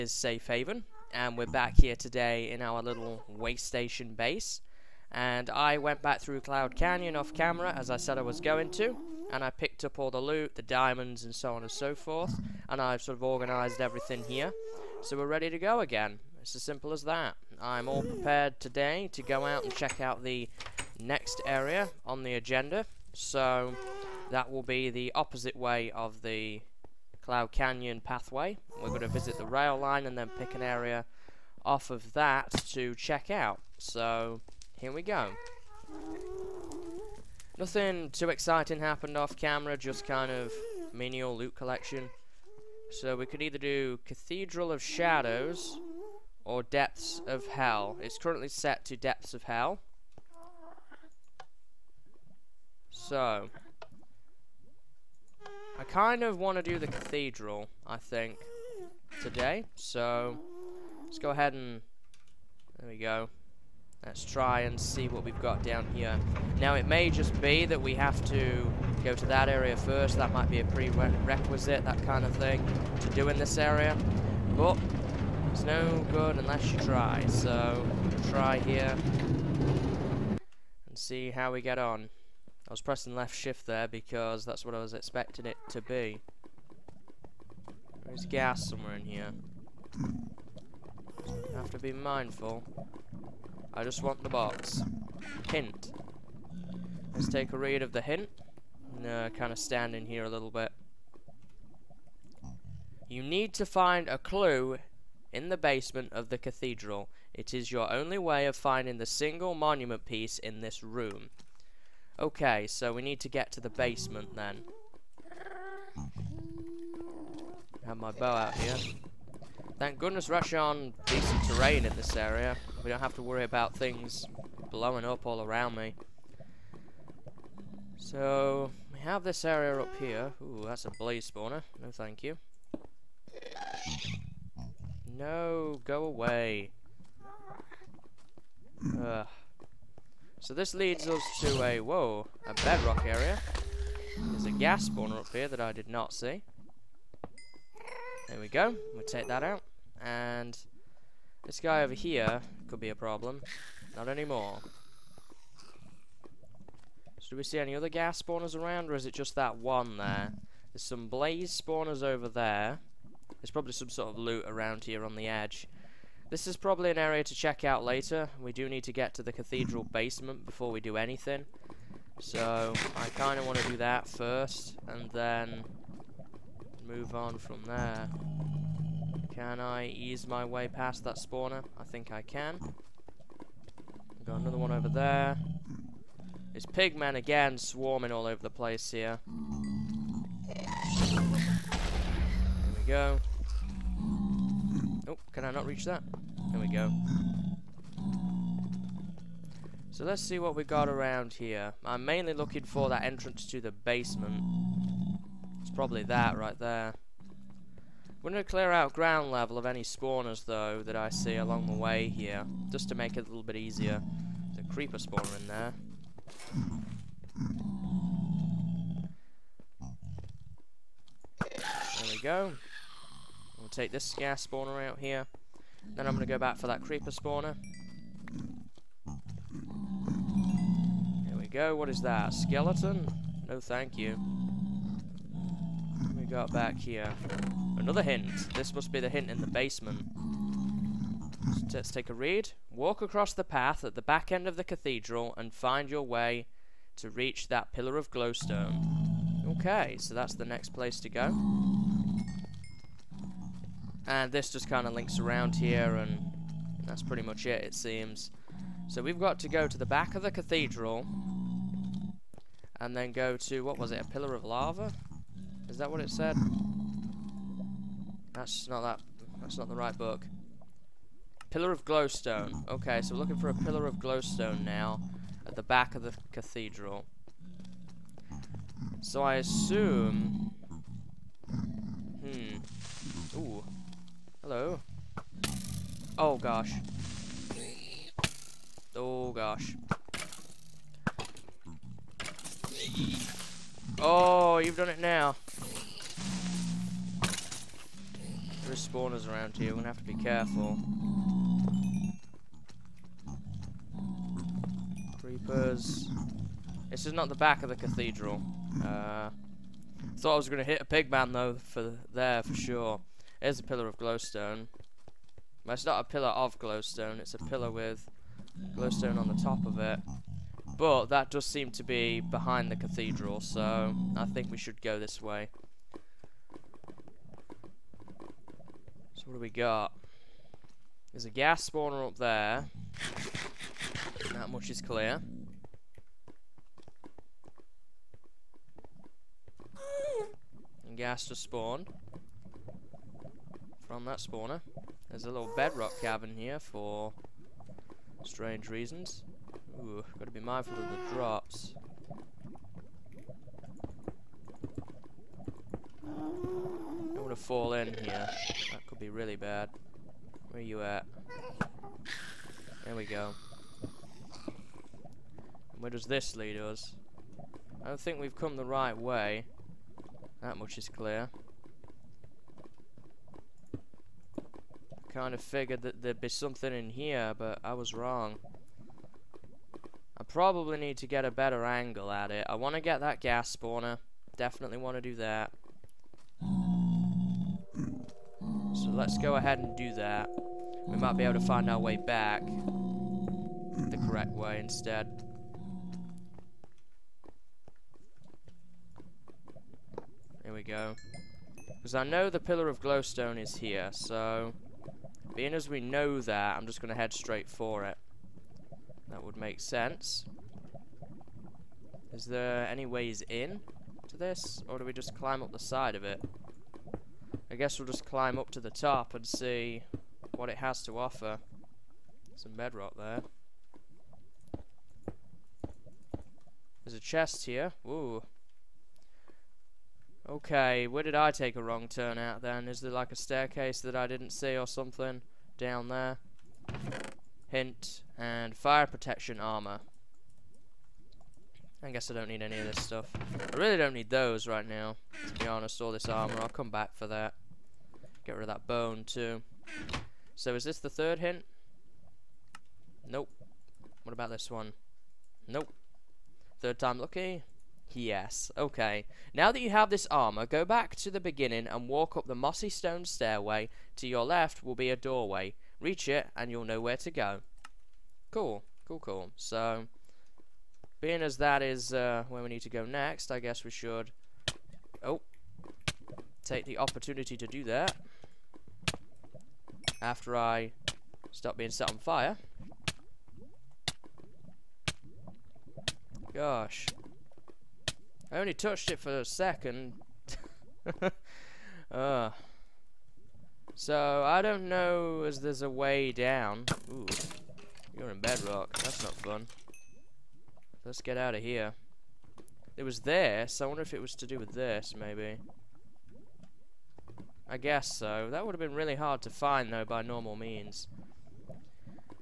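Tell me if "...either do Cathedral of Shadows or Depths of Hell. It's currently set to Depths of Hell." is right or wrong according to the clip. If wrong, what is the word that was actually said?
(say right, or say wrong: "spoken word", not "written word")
right.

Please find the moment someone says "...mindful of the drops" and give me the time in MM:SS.
05:50.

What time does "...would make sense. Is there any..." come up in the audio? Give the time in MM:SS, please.
06:49.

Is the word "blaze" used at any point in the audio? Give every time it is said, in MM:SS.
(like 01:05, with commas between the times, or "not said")
02:10, 02:41.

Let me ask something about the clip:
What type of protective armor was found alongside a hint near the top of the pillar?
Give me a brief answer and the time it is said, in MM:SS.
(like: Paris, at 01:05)
fire protection, at 07:18.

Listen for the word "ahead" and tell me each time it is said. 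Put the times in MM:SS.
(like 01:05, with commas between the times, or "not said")
01:01, 06:29.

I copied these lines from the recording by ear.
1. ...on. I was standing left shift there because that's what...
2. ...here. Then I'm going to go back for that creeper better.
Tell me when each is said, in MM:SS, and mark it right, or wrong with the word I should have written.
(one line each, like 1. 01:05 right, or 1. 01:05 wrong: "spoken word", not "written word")
1. 01:21 wrong: "pressing", not "standing"
2. 03:44 wrong: "spawner", not "better".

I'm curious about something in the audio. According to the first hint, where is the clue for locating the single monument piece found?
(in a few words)
the basement of the cathedral.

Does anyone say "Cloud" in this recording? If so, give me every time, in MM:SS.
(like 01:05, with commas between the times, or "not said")
00:06, 00:27.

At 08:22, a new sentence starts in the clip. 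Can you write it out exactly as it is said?
It was there, so I wonder if it was to do with this, maybe.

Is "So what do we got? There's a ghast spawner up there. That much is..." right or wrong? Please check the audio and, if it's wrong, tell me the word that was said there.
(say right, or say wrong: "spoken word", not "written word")
right.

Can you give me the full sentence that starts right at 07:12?
Is there like a staircase that I didn't see or something?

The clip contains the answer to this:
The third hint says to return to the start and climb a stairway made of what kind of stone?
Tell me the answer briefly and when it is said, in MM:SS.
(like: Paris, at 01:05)
mossy stone, at 07:42.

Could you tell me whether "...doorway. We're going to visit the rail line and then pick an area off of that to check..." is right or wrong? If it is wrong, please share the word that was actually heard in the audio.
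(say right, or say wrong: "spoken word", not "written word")
wrong: "pathway", not "doorway".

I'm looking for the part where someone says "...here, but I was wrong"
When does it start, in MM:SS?
06:16.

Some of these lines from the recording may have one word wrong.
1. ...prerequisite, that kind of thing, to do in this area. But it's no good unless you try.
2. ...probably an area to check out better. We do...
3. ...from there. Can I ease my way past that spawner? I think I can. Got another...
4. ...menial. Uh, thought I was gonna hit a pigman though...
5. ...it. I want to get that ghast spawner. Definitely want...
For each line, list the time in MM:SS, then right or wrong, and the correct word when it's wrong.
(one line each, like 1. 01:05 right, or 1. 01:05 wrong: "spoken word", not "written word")
1. 01:10 right
2. 02:46 wrong: "later", not "better"
3. 02:57 right
4. 05:07 wrong: "cathedral", not "menial"
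5. 06:22 right.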